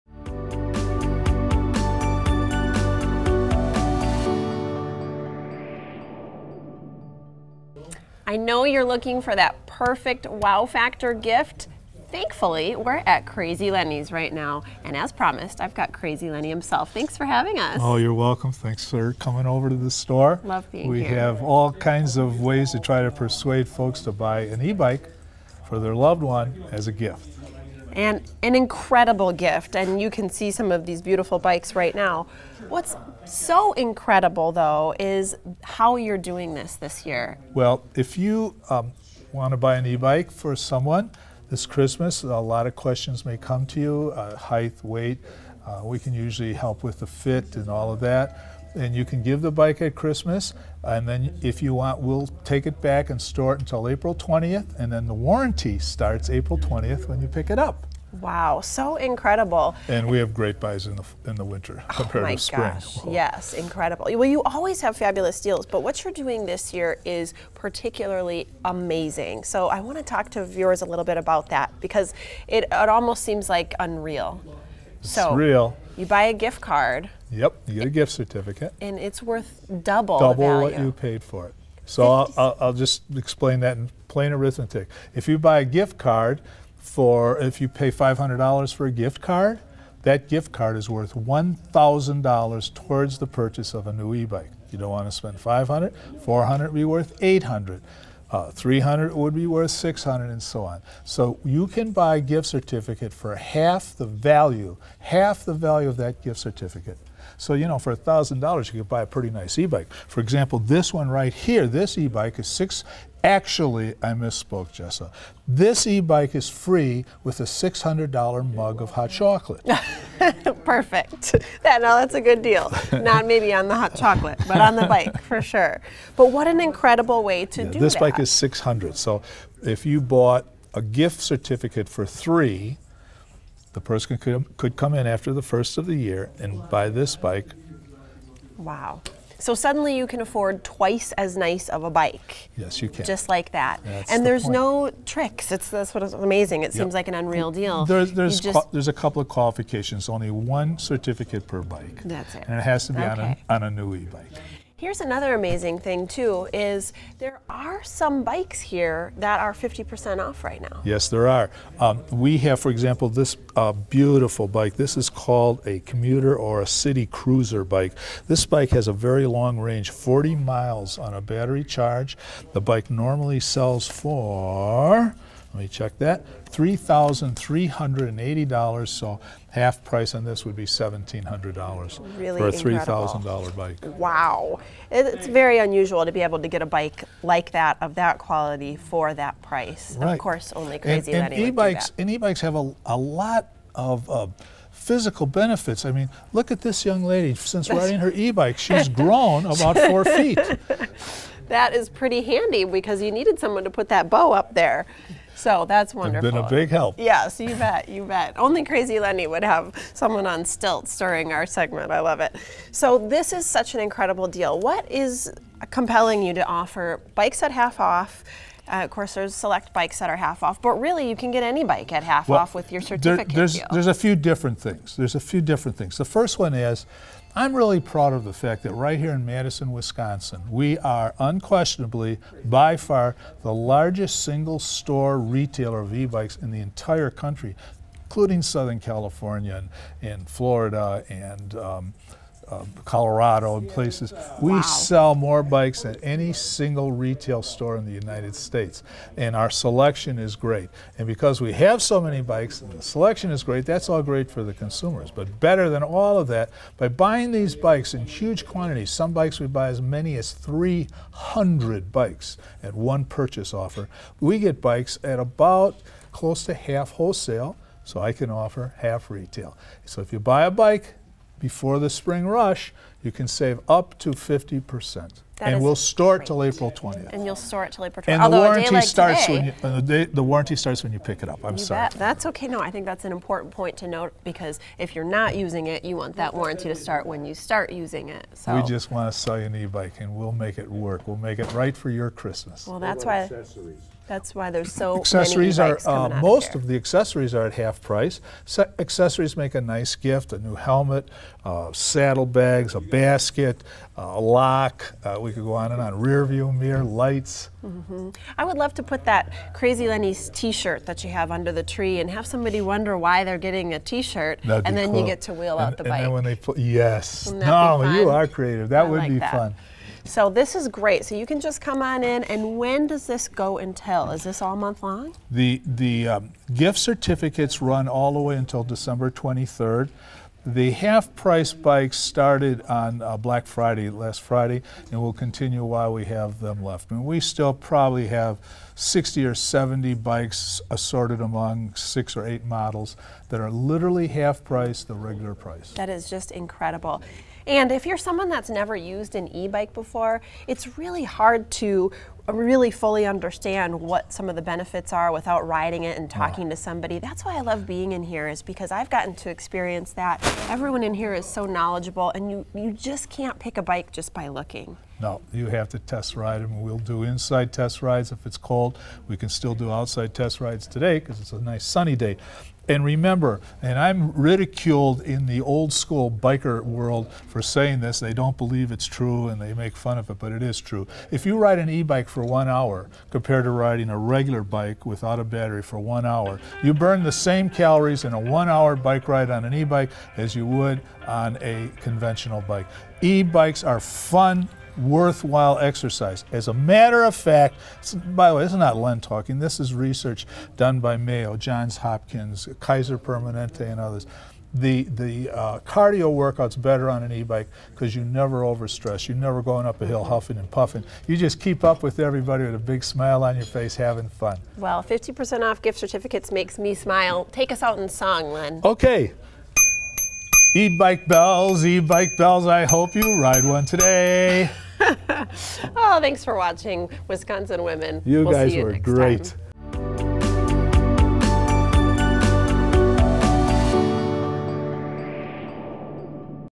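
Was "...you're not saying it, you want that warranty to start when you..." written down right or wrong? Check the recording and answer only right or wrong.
wrong.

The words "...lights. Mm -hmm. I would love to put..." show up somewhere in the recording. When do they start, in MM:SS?
05:06.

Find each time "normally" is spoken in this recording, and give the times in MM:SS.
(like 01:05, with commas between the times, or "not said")
02:52.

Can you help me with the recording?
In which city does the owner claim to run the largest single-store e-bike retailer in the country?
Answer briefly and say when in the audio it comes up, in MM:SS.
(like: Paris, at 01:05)
Madison, Wisconsin, at 03:49.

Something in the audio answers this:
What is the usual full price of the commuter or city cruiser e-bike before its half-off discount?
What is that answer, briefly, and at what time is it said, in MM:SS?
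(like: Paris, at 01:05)
$3,380, at 02:56.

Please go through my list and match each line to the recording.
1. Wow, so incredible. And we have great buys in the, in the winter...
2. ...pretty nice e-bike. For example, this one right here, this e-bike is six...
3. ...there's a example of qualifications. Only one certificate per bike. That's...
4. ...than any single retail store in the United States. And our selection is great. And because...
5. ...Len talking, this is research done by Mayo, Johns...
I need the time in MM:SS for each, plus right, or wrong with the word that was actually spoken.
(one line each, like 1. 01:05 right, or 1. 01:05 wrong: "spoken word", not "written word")
1. 00:58 right
2. 01:49 right
3. 02:28 wrong: "couple", not "example"
4. 04:05 right
5. 06:38 right.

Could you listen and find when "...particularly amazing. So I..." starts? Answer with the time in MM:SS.
01:07.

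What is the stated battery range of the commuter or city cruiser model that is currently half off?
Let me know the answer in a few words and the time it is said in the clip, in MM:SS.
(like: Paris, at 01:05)
40 miles, at 02:49.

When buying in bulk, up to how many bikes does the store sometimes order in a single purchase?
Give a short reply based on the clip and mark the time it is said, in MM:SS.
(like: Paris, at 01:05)
300, at 04:20.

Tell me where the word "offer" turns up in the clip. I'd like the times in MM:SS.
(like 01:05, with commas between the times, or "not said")
03:36, 04:23, 04:28.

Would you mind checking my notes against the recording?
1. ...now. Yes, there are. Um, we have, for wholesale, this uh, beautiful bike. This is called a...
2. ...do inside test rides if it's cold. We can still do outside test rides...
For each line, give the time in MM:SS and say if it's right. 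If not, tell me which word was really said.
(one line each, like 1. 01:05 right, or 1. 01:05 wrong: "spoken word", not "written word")
1. 02:40 wrong: "example", not "wholesale"
2. 06:06 right.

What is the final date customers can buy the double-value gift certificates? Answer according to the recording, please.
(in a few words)
December 23rd.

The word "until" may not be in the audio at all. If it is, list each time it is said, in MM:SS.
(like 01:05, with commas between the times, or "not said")
00:53, 05:23, 05:28.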